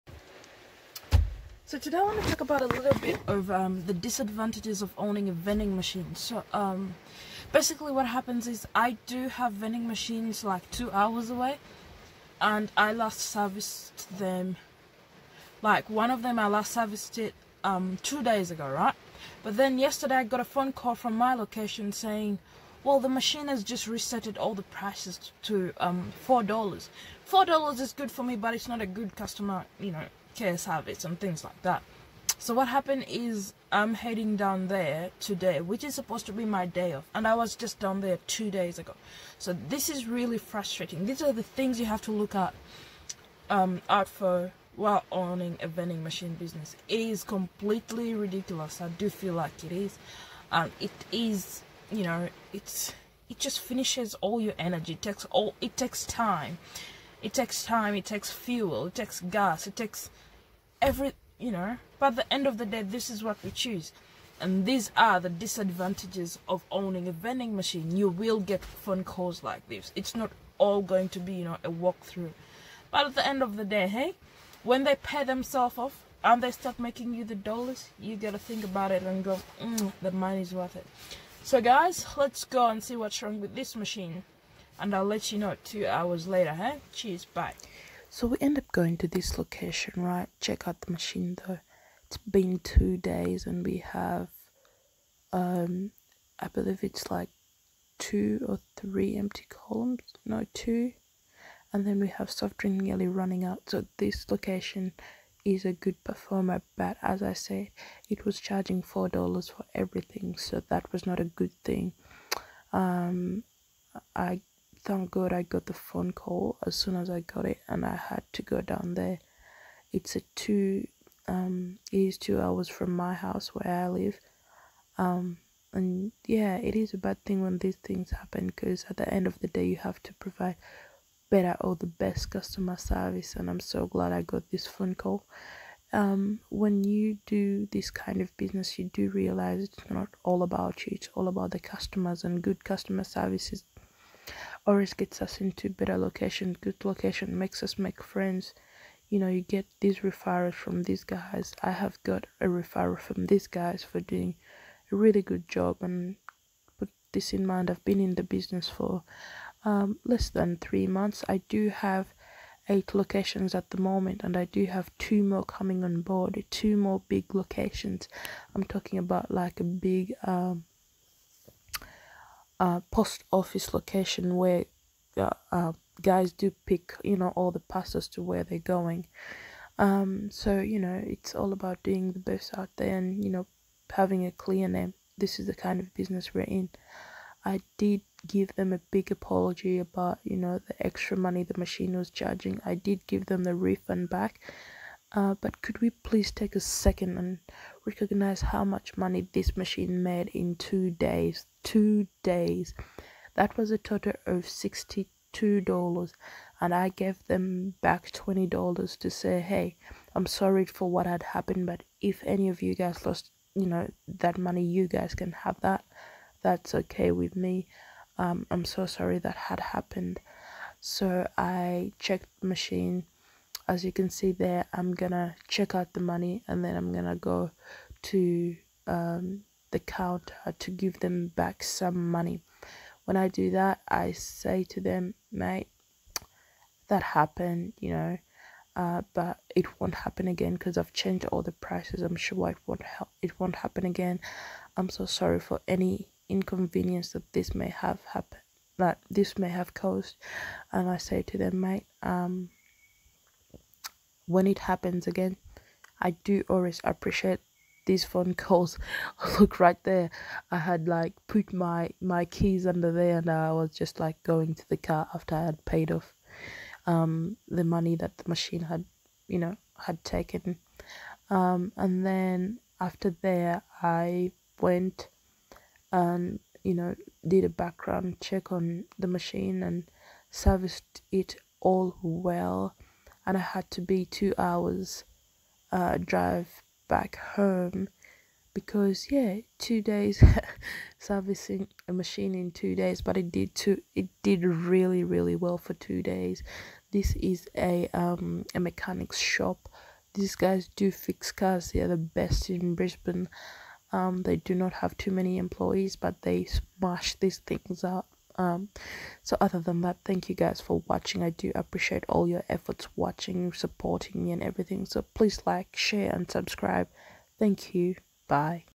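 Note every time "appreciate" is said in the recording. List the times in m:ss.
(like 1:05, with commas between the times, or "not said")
4:16, 5:11.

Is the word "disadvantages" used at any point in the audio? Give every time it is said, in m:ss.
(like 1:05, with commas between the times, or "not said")
0:03, 1:05.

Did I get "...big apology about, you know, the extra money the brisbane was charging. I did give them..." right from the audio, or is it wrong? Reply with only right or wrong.
wrong.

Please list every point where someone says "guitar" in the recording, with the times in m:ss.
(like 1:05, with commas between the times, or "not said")
not said.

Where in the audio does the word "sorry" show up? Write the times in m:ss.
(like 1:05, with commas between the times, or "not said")
3:30, 3:38, 4:05.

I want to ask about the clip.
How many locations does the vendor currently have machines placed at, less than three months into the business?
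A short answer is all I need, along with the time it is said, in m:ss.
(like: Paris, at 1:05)
8, at 2:42.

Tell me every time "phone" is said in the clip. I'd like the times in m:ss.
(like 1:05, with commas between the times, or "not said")
0:20, 1:08, 1:55, 2:14, 4:18.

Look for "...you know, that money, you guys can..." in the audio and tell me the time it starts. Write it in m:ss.
3:33.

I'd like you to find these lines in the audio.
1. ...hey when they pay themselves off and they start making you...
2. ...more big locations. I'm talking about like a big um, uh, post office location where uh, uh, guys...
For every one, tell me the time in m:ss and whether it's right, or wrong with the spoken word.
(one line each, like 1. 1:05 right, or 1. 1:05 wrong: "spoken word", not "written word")
1. 1:13 right
2. 2:46 right.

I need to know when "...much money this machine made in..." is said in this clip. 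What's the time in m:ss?
3:18.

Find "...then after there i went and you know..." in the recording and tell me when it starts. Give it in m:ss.
4:32.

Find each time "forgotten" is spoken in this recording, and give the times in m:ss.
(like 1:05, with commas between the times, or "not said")
not said.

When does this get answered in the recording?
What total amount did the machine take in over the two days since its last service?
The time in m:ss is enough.
3:24.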